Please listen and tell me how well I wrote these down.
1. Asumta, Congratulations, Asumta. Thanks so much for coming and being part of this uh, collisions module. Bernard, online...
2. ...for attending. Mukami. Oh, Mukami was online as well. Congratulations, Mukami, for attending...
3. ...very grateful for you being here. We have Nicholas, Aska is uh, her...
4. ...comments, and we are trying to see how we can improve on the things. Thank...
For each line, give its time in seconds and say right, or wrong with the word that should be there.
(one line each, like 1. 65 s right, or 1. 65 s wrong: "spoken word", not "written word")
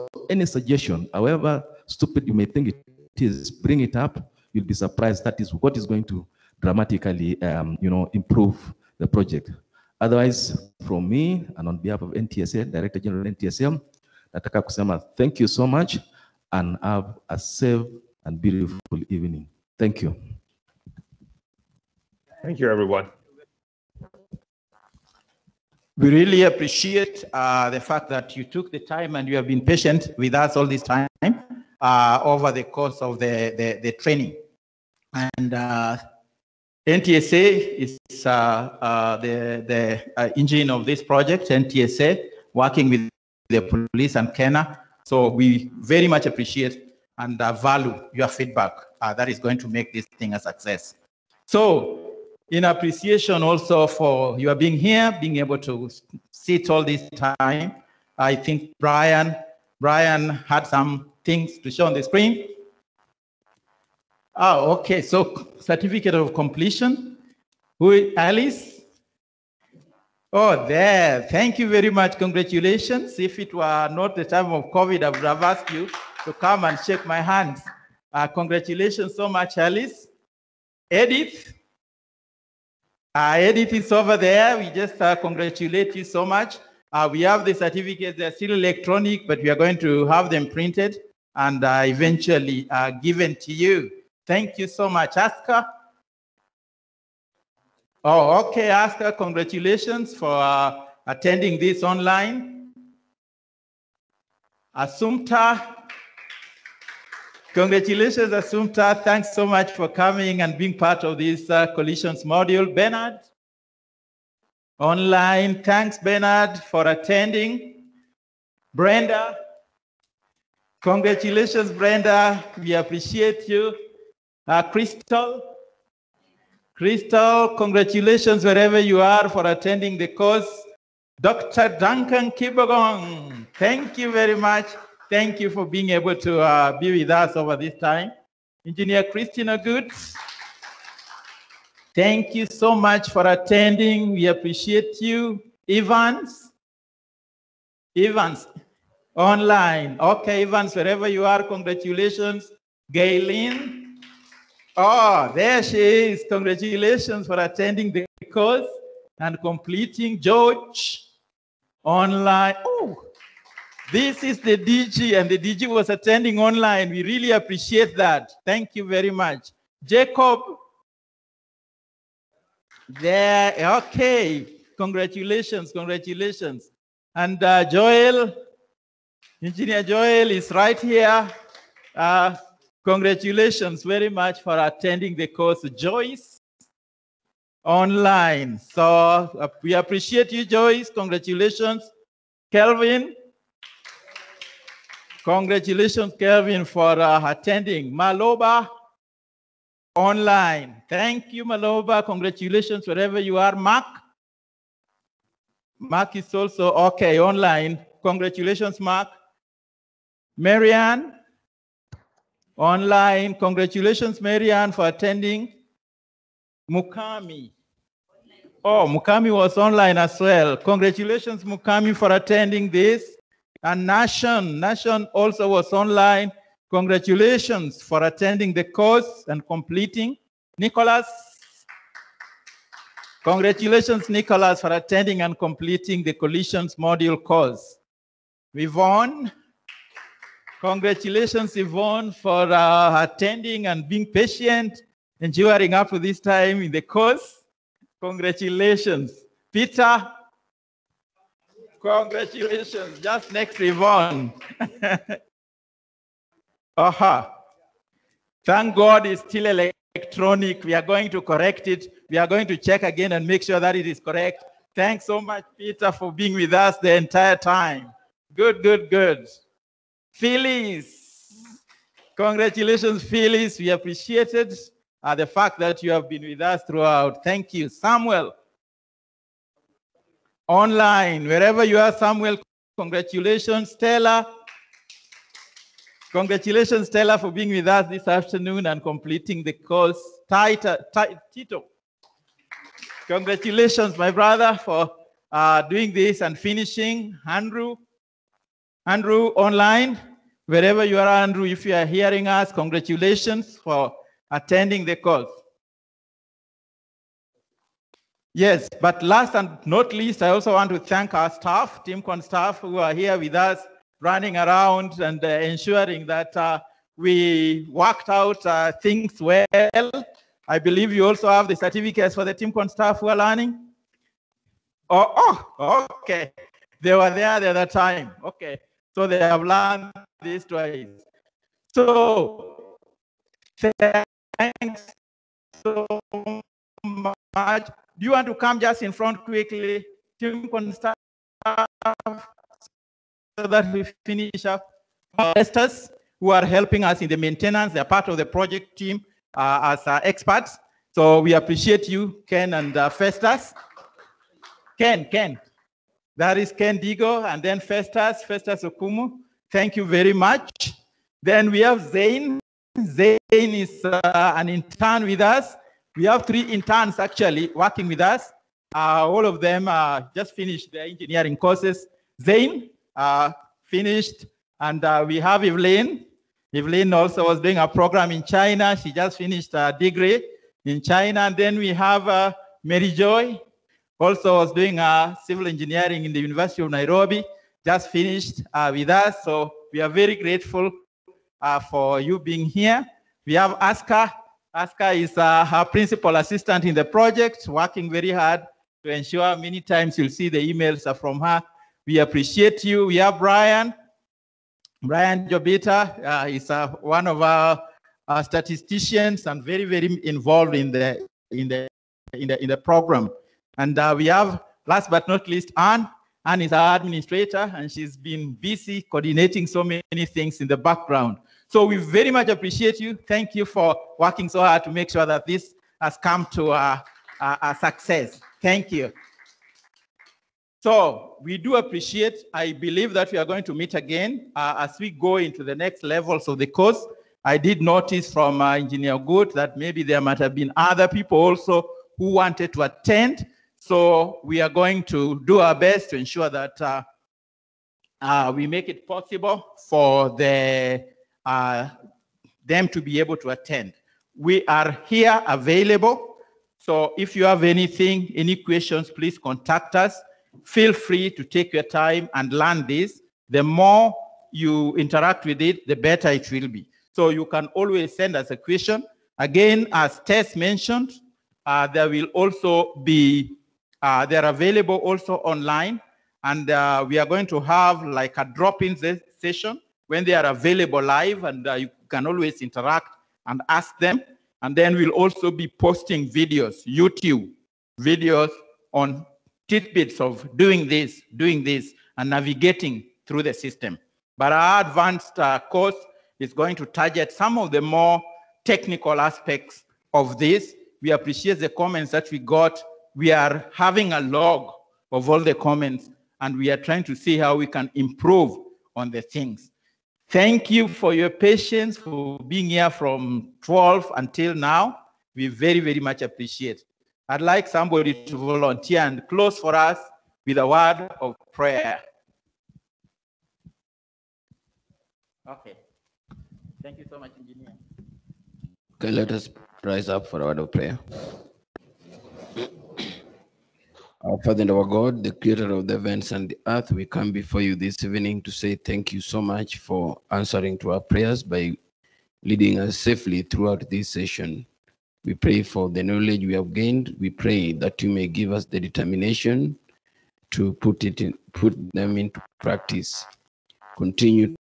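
1. 104 s right
2. 214 s right
3. 389 s wrong: "Aska", not "Nicholas"
4. 505 s right.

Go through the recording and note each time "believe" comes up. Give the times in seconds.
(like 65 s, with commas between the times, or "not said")
320 s, 432 s.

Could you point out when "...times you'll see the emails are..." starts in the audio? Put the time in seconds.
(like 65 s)
399 s.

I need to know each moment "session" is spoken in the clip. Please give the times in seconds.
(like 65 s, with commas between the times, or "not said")
479 s, 543 s.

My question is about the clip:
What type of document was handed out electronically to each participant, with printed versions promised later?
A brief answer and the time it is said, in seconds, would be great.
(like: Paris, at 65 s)
Certificate of completion, at 65 s.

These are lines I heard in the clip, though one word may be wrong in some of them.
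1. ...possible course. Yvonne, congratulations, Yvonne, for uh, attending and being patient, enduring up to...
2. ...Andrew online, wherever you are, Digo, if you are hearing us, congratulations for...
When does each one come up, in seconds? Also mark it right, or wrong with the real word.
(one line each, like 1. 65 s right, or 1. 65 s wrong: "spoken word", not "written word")
1. 236 s wrong: "module", not "possible"
2. 298 s wrong: "Andrew", not "Digo".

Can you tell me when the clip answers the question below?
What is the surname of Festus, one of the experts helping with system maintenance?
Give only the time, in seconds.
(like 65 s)
358 s.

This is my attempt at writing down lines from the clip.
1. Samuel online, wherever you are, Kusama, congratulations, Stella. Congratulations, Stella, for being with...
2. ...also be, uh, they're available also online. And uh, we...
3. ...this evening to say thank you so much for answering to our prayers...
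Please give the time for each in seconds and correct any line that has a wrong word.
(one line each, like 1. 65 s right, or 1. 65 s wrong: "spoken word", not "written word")
1. 277 s wrong: "Samuel", not "Kusama"
2. 472 s right
3. 537 s right.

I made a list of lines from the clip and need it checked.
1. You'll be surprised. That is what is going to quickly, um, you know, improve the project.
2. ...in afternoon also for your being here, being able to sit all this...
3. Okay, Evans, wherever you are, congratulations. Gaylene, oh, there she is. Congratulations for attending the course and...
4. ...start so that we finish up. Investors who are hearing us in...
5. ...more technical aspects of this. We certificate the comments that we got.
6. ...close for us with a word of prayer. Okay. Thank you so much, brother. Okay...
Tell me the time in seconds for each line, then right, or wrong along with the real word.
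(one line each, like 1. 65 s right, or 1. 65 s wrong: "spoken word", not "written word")
1. 4 s wrong: "dramatically", not "quickly"
2. 52 s wrong: "appreciation", not "afternoon"
3. 150 s right
4. 340 s wrong: "helping", not "hearing"
5. 497 s wrong: "appreciate", not "certificate"
6. 519 s wrong: "engineer", not "brother".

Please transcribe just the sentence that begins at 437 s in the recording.
I did notice from uh, Engineer Good that maybe there might have been other people also who wanted to attend.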